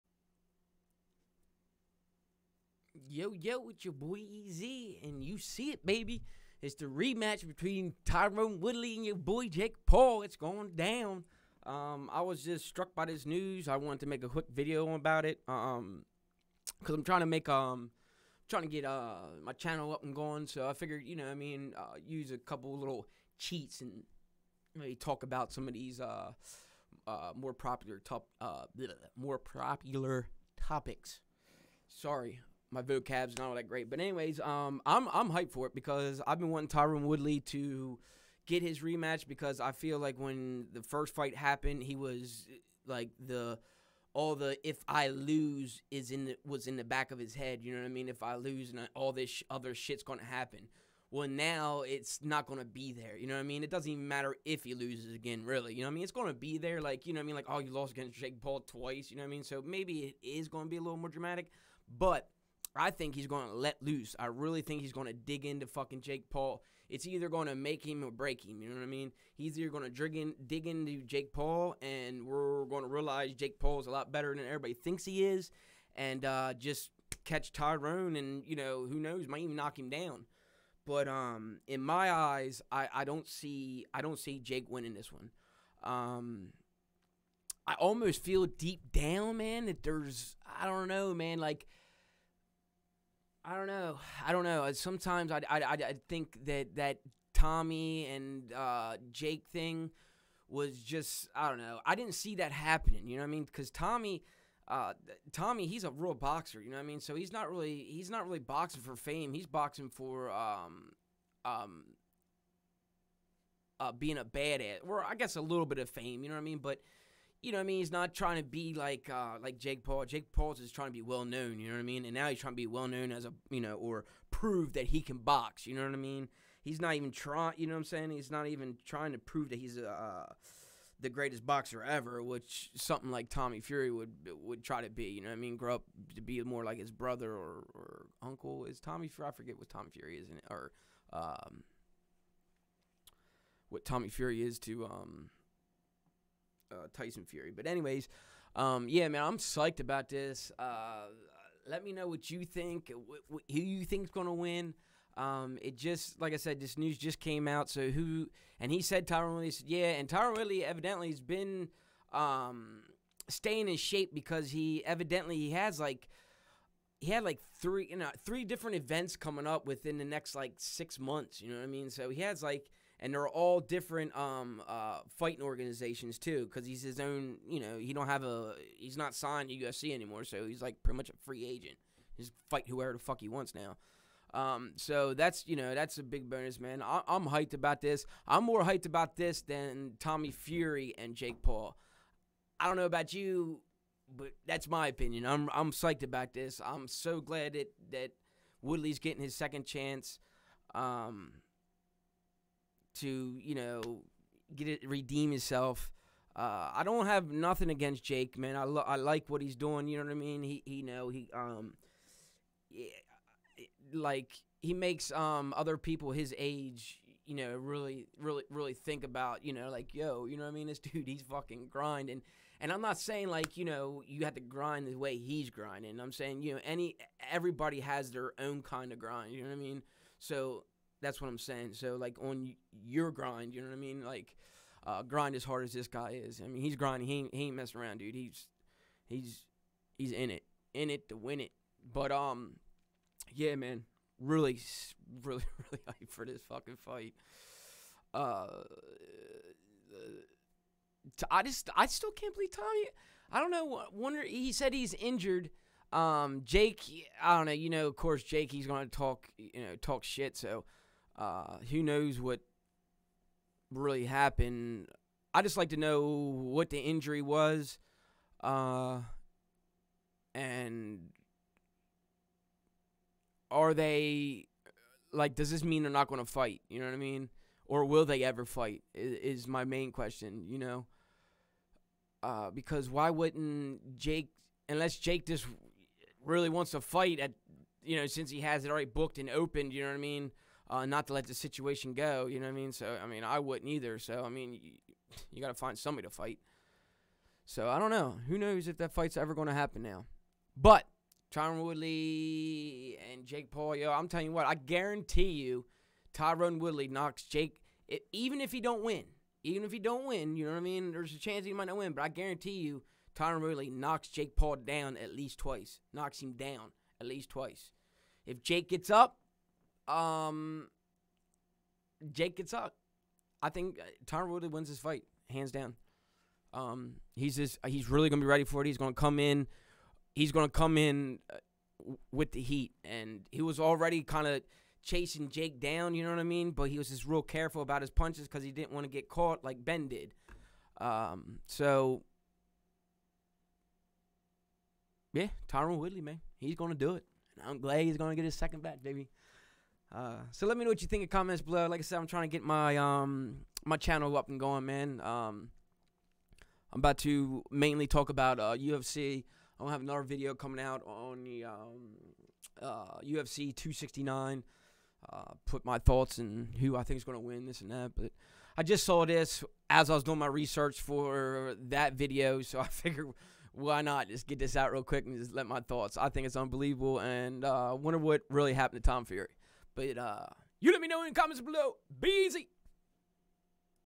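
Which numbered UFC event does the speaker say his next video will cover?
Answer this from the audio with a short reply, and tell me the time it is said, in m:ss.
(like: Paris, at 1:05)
UFC 269, at 6:03.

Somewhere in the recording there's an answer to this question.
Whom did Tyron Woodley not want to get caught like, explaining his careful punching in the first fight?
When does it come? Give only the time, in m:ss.
5:39.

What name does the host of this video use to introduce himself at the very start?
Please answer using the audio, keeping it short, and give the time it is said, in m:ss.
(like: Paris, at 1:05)
EZ, at 0:04.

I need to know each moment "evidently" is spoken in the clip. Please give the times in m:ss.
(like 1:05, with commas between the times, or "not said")
2:40, 2:44.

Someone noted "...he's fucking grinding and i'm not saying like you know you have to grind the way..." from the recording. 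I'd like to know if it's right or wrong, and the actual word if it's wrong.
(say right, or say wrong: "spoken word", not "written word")
right.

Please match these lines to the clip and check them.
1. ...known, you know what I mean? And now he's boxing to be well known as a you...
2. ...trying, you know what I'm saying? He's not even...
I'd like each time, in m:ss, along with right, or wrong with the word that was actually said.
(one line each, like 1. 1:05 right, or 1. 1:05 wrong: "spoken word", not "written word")
1. 2:01 wrong: "trying", not "boxing"
2. 2:07 right.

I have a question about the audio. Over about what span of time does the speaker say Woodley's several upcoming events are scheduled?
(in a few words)
6 months.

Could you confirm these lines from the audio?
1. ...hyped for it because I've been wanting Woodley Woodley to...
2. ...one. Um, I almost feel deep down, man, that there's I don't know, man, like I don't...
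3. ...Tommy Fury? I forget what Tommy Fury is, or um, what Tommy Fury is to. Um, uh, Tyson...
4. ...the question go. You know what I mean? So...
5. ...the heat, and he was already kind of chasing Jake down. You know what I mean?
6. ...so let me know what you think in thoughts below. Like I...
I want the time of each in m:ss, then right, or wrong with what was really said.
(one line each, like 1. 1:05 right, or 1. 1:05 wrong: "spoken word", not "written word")
1. 0:35 wrong: "Tyron", not "Woodley"
2. 1:25 right
3. 2:18 right
4. 4:51 wrong: "situation", not "question"
5. 5:32 right
6. 5:50 wrong: "comments", not "thoughts".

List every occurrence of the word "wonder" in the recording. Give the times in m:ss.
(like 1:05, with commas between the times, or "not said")
4:13, 6:17.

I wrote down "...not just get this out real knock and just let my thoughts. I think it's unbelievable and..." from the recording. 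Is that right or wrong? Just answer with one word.
wrong.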